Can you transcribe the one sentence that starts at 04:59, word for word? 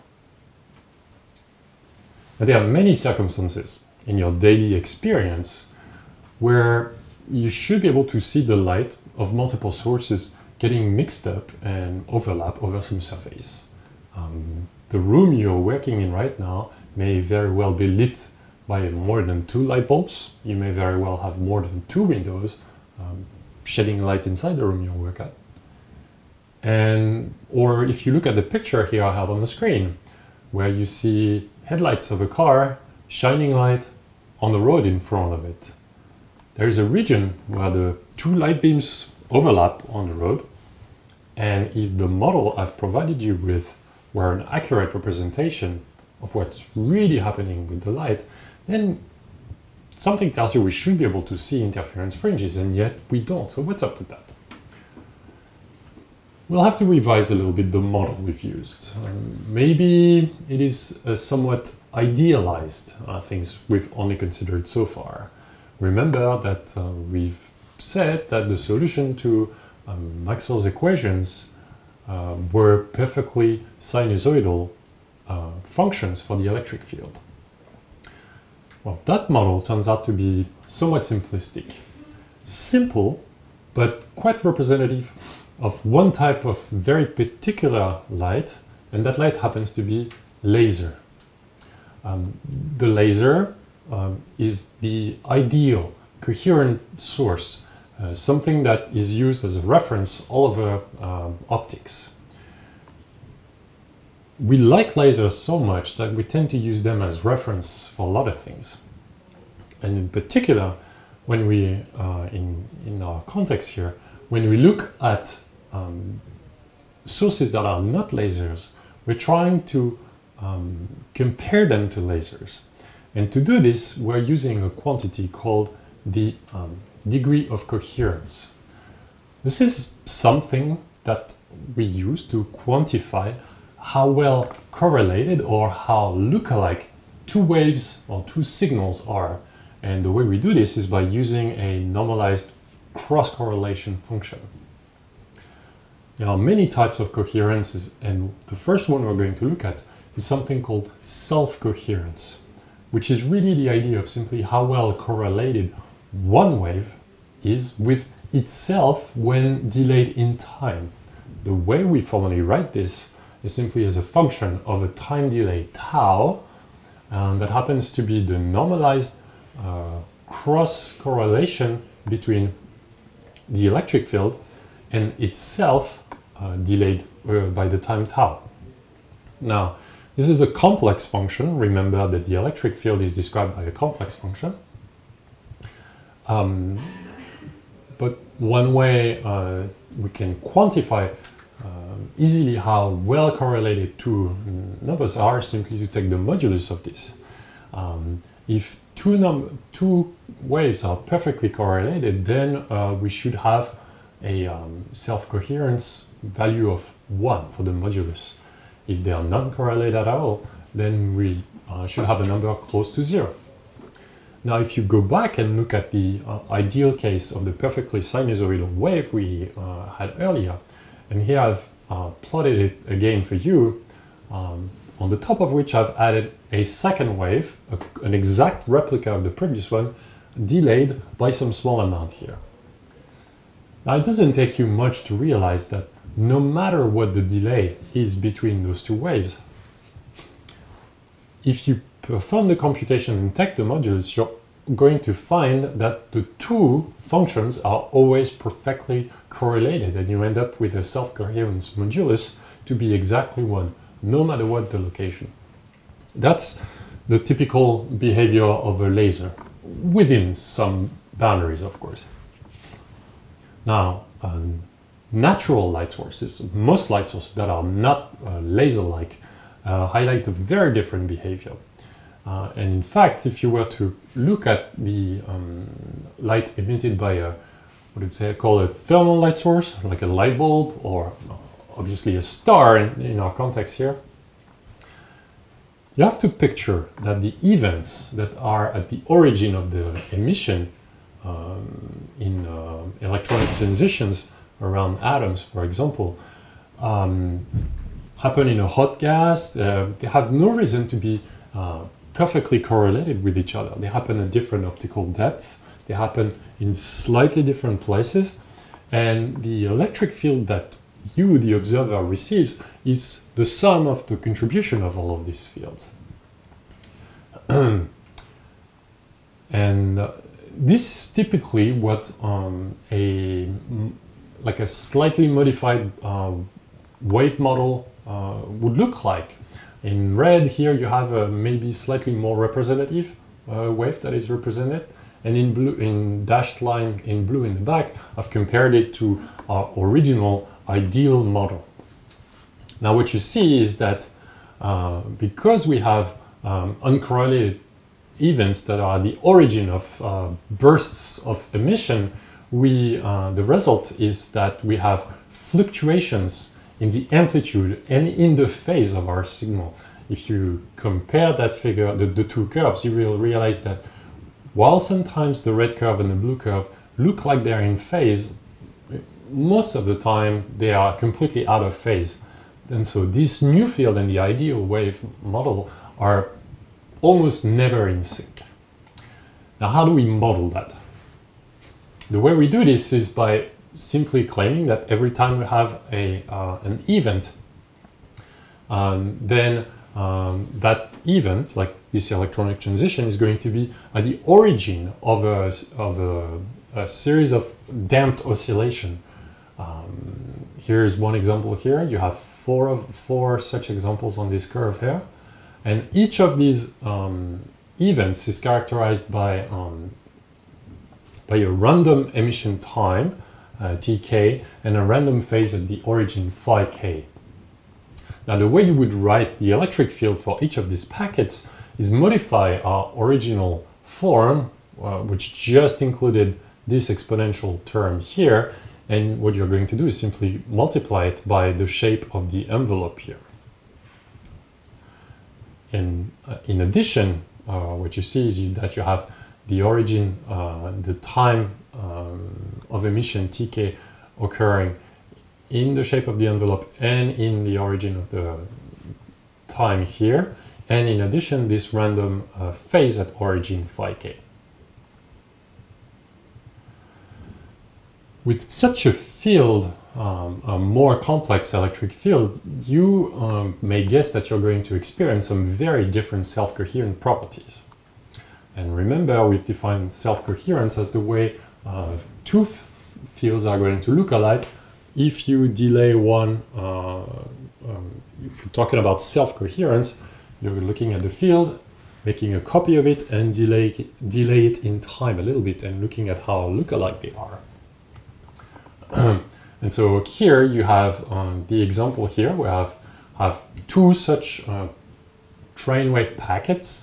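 Uh, they have no reason to be uh, perfectly correlated with each other.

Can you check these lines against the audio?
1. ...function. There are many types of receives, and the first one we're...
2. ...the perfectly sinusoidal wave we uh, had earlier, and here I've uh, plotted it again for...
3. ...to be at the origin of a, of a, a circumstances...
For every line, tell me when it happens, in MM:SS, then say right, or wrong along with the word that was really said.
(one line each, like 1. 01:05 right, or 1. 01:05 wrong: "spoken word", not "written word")
1. 02:23 wrong: "coherences", not "receives"
2. 03:37 right
3. 06:33 wrong: "series", not "circumstances".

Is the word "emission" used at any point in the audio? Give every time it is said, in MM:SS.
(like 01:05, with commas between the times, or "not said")
04:50, 05:51, 06:52, 07:22.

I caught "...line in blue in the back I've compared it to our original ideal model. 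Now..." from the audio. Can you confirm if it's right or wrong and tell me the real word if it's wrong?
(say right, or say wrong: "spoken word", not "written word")
right.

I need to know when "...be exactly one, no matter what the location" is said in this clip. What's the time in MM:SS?
04:12.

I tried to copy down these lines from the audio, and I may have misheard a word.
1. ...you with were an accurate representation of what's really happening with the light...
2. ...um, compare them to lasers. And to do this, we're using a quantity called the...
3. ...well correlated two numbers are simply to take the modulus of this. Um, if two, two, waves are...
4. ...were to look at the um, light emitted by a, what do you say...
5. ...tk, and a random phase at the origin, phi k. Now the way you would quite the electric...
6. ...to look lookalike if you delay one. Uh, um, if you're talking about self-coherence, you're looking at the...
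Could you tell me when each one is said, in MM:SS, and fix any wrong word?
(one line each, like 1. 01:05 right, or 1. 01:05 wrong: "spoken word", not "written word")
1. 00:43 right
2. 02:00 right
3. 03:12 right
4. 04:33 right
5. 06:53 wrong: "write", not "quite"
6. 07:53 wrong: "alike", not "lookalike".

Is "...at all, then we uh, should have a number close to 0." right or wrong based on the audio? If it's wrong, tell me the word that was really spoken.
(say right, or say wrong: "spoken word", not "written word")
right.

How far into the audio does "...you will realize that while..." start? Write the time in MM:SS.
06:02.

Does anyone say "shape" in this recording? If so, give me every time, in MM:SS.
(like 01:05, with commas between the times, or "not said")
07:11, 07:25.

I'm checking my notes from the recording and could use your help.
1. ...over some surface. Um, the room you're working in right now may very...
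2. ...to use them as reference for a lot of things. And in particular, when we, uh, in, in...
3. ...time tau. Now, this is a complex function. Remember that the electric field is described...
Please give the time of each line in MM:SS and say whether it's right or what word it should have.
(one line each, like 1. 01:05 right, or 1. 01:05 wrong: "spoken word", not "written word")
1. 00:12 right
2. 01:46 right
3. 02:57 right.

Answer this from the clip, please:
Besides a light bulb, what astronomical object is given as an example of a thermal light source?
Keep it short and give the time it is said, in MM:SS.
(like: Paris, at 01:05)
a star, at 04:42.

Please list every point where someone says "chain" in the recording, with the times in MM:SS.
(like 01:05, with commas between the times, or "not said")
not said.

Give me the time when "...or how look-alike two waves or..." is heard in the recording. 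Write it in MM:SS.
02:15.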